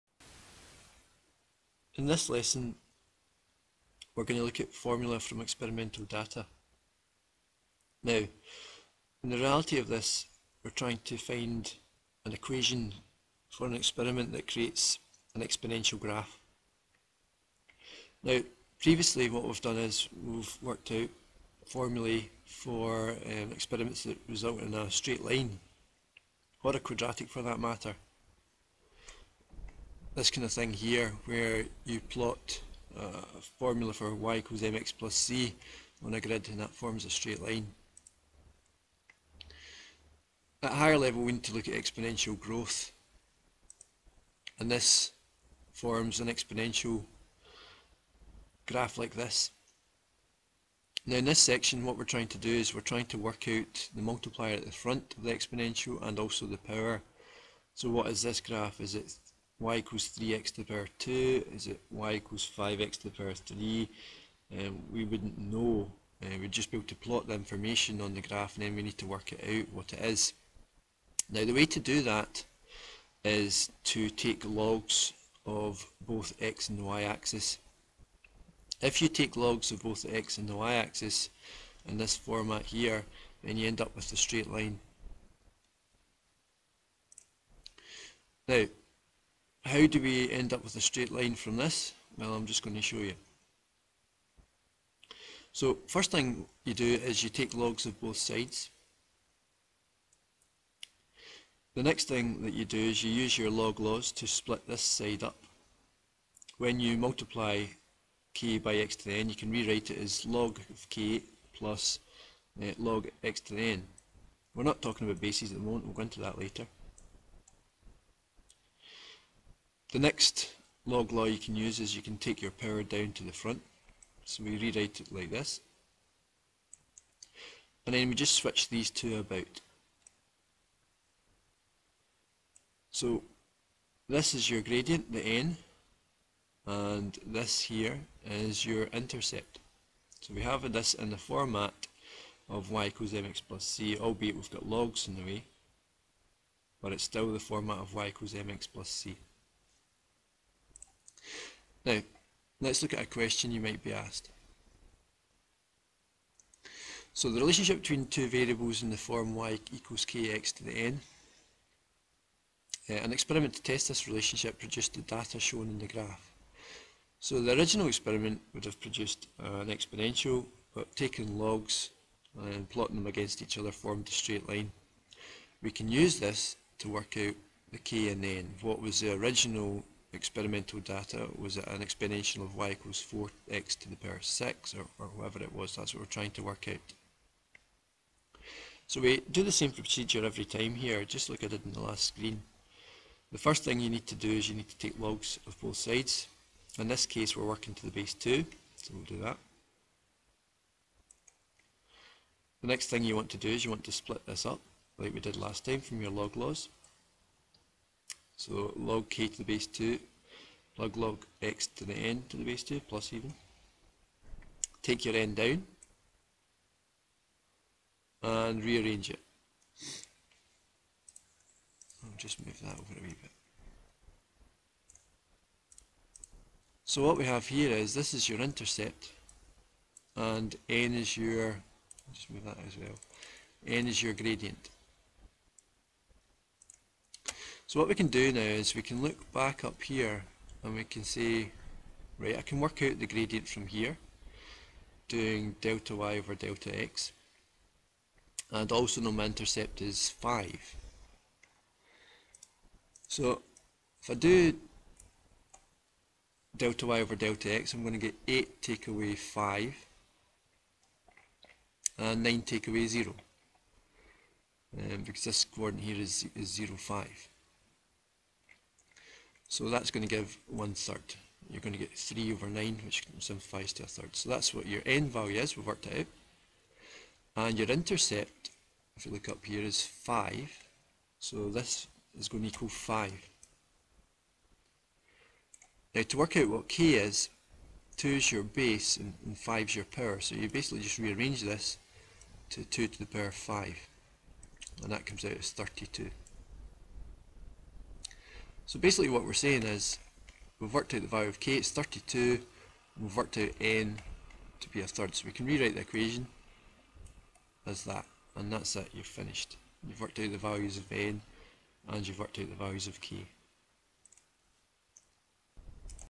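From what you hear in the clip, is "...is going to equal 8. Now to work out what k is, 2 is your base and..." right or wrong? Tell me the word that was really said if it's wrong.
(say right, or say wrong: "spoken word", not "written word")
wrong: "5", not "8".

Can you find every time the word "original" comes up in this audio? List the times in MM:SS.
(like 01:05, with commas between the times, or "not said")
02:47, 02:59.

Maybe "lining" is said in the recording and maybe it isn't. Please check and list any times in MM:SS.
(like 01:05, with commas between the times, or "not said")
not said.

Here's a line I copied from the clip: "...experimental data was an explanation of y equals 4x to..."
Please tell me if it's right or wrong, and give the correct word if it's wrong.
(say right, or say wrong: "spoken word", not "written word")
right.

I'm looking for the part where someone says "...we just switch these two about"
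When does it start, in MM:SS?
02:08.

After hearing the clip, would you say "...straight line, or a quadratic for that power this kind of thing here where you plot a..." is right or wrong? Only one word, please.
wrong.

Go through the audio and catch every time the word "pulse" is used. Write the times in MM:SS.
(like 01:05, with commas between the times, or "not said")
not said.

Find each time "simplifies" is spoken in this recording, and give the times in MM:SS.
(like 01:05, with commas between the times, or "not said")
04:33.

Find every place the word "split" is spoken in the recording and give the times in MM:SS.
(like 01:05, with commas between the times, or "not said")
01:44, 03:23.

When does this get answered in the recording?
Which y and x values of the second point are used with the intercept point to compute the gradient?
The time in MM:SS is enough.
04:18.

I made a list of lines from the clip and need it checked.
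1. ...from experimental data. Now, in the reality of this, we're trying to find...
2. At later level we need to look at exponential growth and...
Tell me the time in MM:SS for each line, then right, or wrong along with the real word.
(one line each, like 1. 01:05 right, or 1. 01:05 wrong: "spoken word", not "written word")
1. 00:05 right
2. 00:40 wrong: "higher", not "later".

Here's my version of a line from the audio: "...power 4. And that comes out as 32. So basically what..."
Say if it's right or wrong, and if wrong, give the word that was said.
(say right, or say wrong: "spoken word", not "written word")
wrong: "5", not "4".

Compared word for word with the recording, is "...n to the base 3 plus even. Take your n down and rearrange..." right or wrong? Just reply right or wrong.
wrong.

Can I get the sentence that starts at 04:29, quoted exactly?
So that's going to give one third.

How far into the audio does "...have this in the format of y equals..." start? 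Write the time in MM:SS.
02:20.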